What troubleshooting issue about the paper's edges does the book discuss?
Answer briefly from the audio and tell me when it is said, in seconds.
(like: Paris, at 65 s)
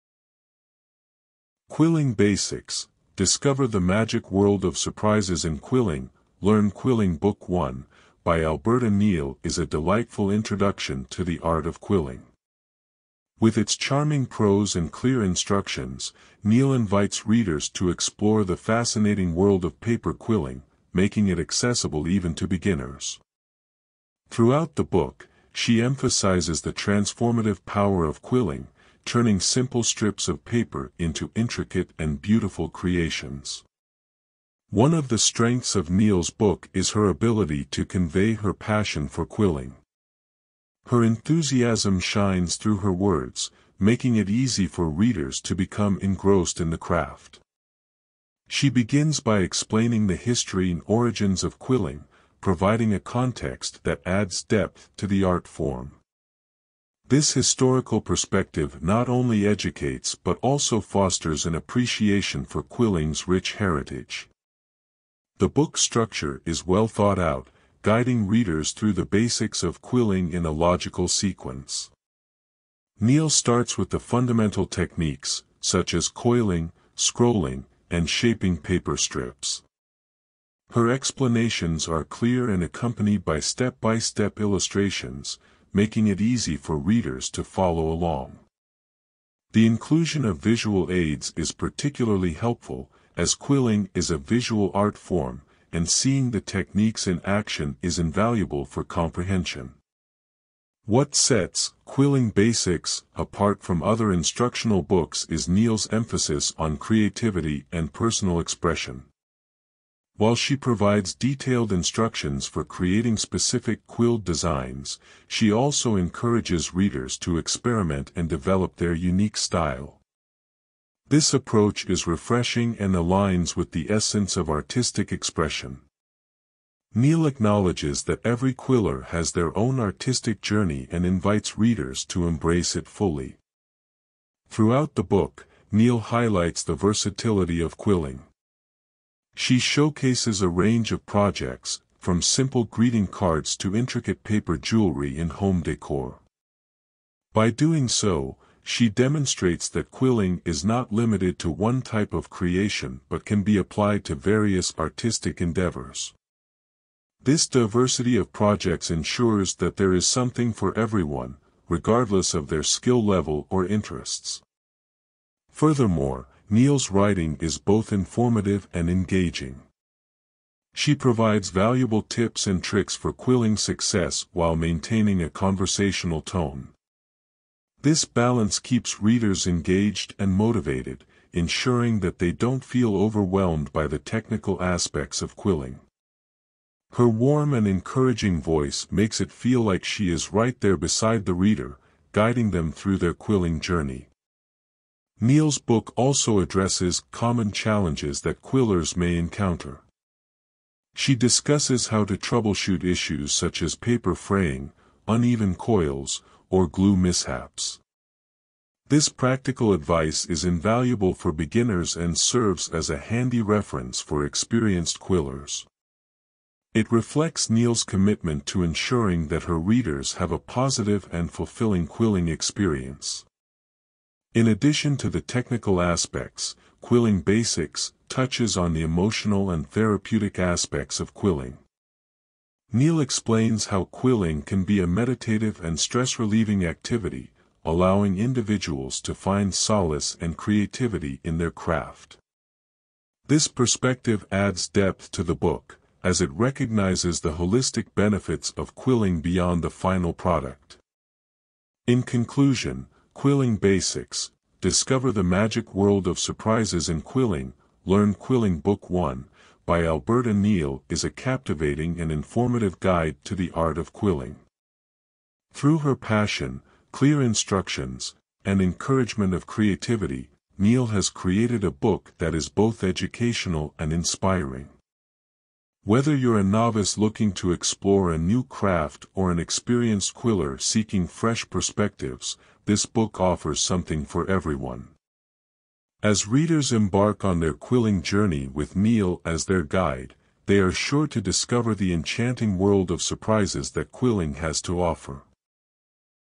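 paper fraying, at 203 s.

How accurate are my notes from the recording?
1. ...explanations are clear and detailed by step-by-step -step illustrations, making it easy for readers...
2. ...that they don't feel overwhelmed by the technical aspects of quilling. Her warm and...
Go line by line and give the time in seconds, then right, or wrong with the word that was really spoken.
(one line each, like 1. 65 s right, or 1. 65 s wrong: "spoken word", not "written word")
1. 80 s wrong: "accompanied", not "detailed"
2. 182 s right.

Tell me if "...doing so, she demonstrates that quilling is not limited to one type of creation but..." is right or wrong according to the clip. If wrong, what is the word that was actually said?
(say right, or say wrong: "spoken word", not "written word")
right.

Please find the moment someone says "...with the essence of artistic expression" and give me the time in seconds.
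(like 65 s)
123 s.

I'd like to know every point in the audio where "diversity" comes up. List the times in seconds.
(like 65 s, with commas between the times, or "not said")
157 s.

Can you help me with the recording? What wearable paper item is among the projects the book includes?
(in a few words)
paper jewelry.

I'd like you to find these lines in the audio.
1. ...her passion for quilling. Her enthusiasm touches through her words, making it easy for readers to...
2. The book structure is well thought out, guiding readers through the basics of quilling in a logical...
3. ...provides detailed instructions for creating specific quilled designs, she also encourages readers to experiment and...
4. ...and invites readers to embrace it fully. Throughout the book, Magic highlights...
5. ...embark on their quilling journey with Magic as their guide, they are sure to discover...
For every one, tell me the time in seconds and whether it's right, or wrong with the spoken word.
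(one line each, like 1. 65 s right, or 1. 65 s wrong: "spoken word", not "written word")
1. 38 s wrong: "shines", not "touches"
2. 65 s right
3. 110 s right
4. 130 s wrong: "Neal", not "Magic"
5. 286 s wrong: "Neal", not "Magic".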